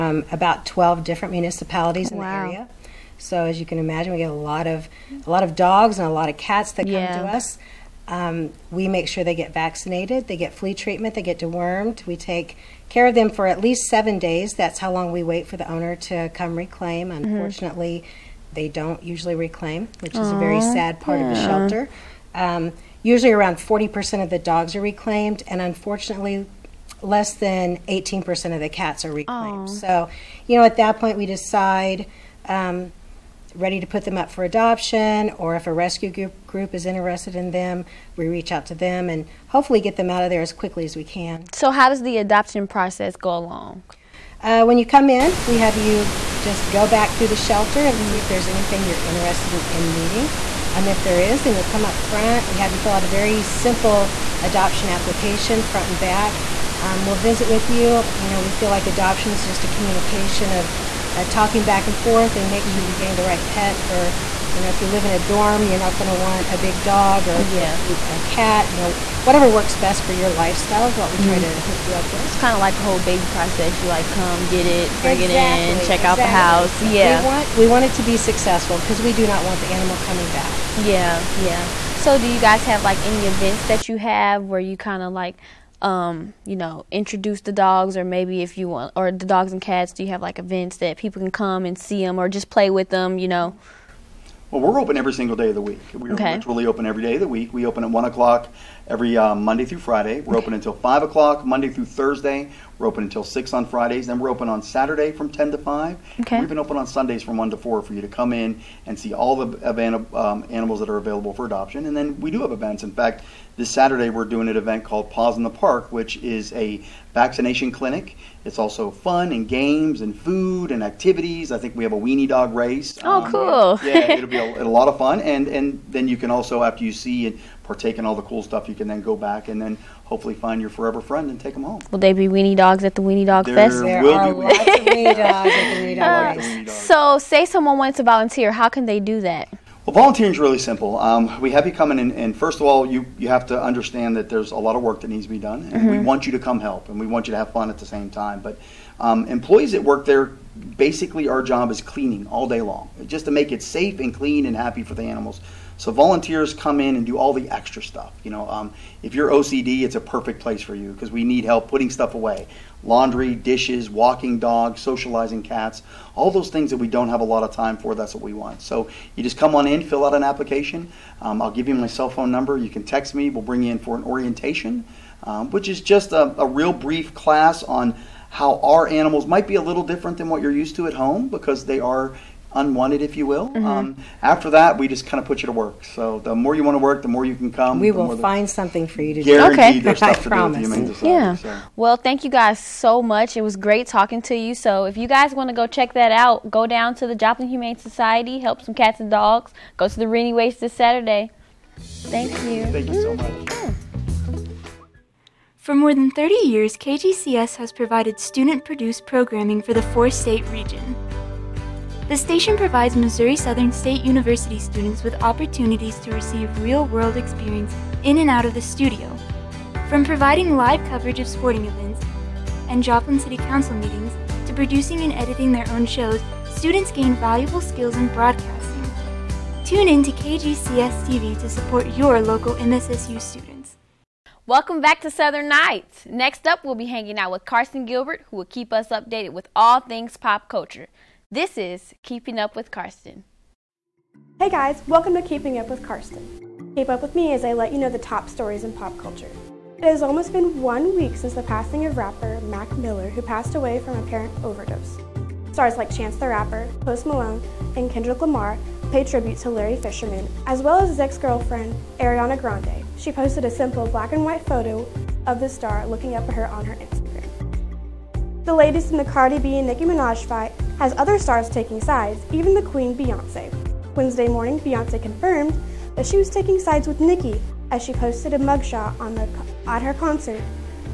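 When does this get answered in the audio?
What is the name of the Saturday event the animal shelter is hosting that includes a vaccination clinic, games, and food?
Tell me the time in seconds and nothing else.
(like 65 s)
115 s.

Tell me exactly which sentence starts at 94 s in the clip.
Well, we're open every single day of the week.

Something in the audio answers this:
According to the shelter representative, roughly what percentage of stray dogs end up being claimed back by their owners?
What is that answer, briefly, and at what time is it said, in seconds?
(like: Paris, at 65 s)
40%, at 23 s.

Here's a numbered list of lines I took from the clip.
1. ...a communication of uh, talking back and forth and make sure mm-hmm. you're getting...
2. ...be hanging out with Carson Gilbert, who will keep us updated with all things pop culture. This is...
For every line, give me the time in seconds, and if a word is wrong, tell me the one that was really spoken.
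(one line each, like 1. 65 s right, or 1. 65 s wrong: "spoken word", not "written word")
1. 59 s right
2. 236 s right.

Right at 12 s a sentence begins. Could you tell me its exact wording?
We take care of them for at least seven days.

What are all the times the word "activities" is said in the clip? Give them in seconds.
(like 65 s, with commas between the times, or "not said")
120 s.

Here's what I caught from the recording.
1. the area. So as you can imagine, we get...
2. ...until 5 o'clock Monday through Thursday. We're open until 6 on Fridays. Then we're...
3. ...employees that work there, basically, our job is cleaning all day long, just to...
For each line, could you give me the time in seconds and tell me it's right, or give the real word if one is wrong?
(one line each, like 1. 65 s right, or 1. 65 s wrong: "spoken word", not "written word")
1. 2 s right
2. 100 s right
3. 149 s right.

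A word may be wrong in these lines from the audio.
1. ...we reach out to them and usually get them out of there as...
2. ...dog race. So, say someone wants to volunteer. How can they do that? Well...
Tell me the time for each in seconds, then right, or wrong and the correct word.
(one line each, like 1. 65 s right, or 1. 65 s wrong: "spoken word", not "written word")
1. 38 s wrong: "hopefully", not "usually"
2. 136 s right.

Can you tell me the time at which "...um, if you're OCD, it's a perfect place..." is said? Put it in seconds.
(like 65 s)
158 s.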